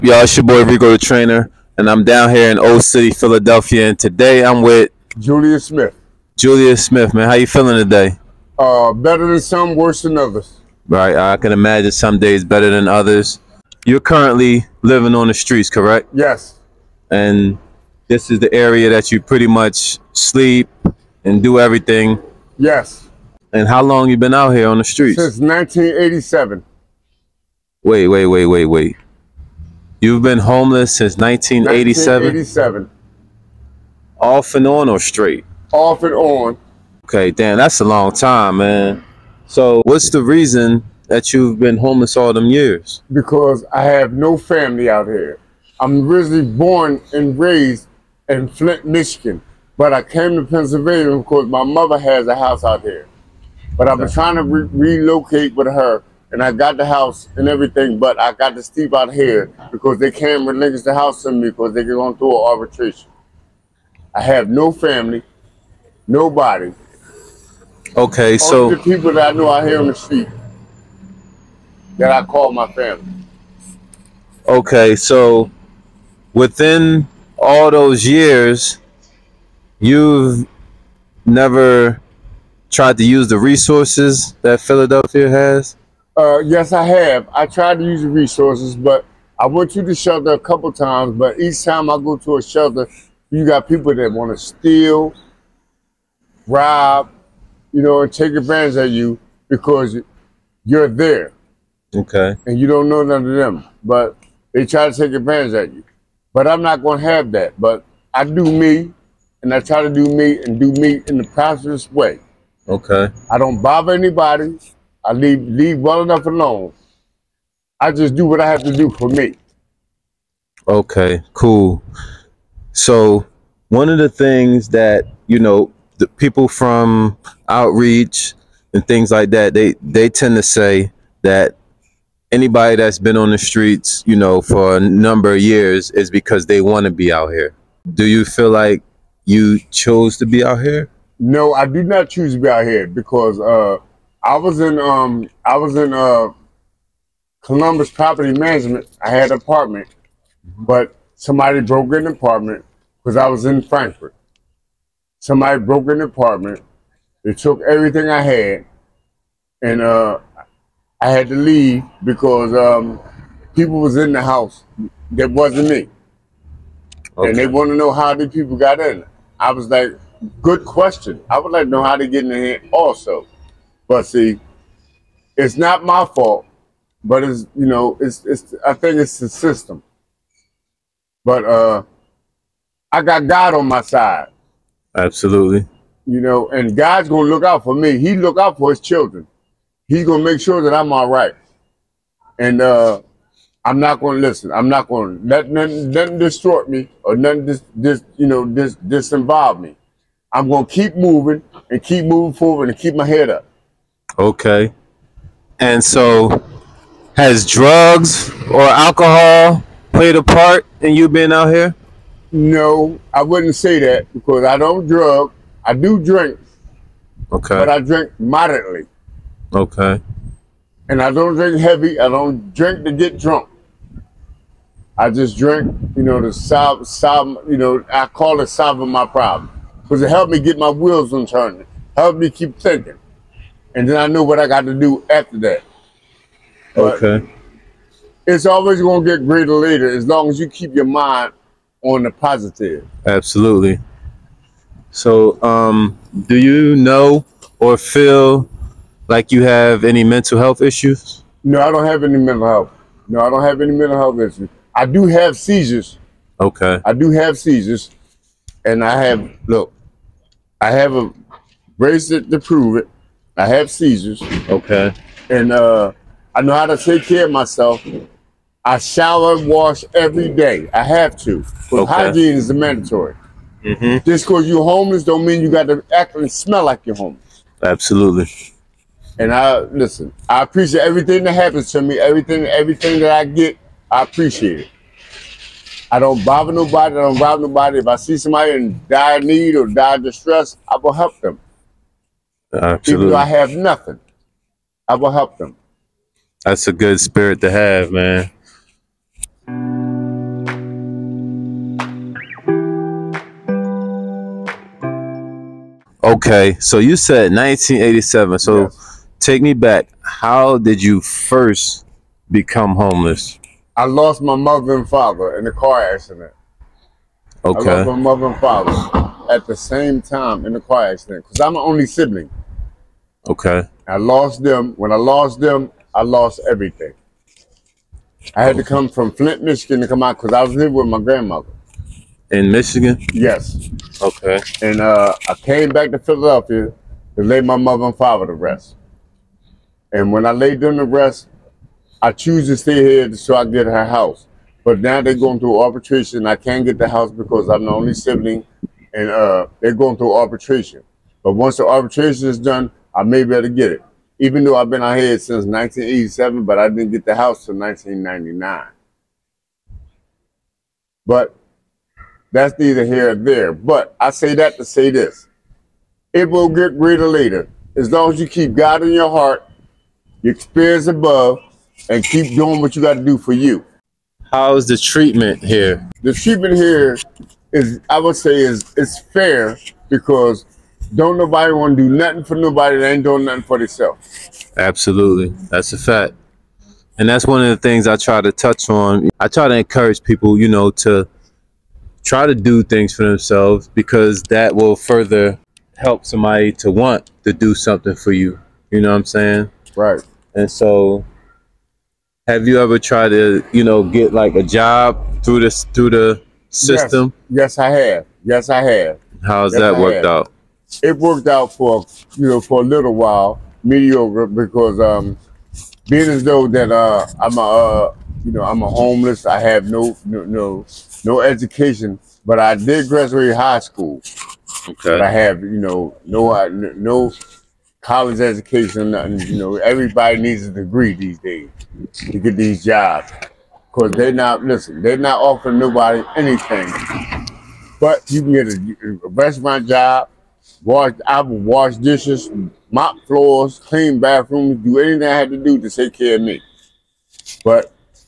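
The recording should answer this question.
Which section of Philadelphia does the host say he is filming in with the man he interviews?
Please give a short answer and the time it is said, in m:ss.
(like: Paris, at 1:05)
Old City, at 0:02.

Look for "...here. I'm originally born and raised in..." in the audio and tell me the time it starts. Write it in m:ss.
0:45.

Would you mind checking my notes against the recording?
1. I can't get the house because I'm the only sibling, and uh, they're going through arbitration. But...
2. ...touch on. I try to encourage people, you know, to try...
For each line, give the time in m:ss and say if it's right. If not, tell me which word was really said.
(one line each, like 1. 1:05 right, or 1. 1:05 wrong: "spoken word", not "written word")
1. 5:46 right
2. 6:28 right.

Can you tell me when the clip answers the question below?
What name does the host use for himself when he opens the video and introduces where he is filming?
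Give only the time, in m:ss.
0:00.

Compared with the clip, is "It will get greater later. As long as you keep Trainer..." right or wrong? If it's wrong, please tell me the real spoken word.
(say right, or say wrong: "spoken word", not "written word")
wrong: "God", not "Trainer".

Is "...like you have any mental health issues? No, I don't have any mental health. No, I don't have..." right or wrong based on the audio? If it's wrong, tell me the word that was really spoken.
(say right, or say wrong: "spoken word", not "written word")
right.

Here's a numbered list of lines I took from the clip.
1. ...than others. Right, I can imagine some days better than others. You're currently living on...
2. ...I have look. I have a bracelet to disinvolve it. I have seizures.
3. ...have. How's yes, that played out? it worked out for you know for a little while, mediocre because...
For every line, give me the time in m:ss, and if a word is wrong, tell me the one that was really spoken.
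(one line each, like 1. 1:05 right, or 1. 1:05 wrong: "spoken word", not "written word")
1. 0:10 right
2. 4:18 wrong: "prove", not "disinvolve"
3. 6:48 wrong: "worked", not "played".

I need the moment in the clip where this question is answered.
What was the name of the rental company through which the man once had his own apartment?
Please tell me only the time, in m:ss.
2:27.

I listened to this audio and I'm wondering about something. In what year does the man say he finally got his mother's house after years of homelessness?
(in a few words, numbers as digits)
1999.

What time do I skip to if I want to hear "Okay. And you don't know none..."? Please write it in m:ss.
1:41.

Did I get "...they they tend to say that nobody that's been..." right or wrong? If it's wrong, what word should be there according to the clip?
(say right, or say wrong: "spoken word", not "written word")
wrong: "anybody", not "nobody".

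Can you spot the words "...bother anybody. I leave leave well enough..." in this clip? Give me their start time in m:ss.
1:53.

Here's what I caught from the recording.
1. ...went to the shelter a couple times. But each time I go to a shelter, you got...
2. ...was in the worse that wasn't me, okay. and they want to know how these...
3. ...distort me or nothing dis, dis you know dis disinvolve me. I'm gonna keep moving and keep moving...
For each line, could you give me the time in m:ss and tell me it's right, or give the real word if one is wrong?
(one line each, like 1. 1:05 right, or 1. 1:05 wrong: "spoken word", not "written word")
1. 1:29 right
2. 2:43 wrong: "house", not "worse"
3. 3:16 right.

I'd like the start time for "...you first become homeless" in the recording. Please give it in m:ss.
5:10.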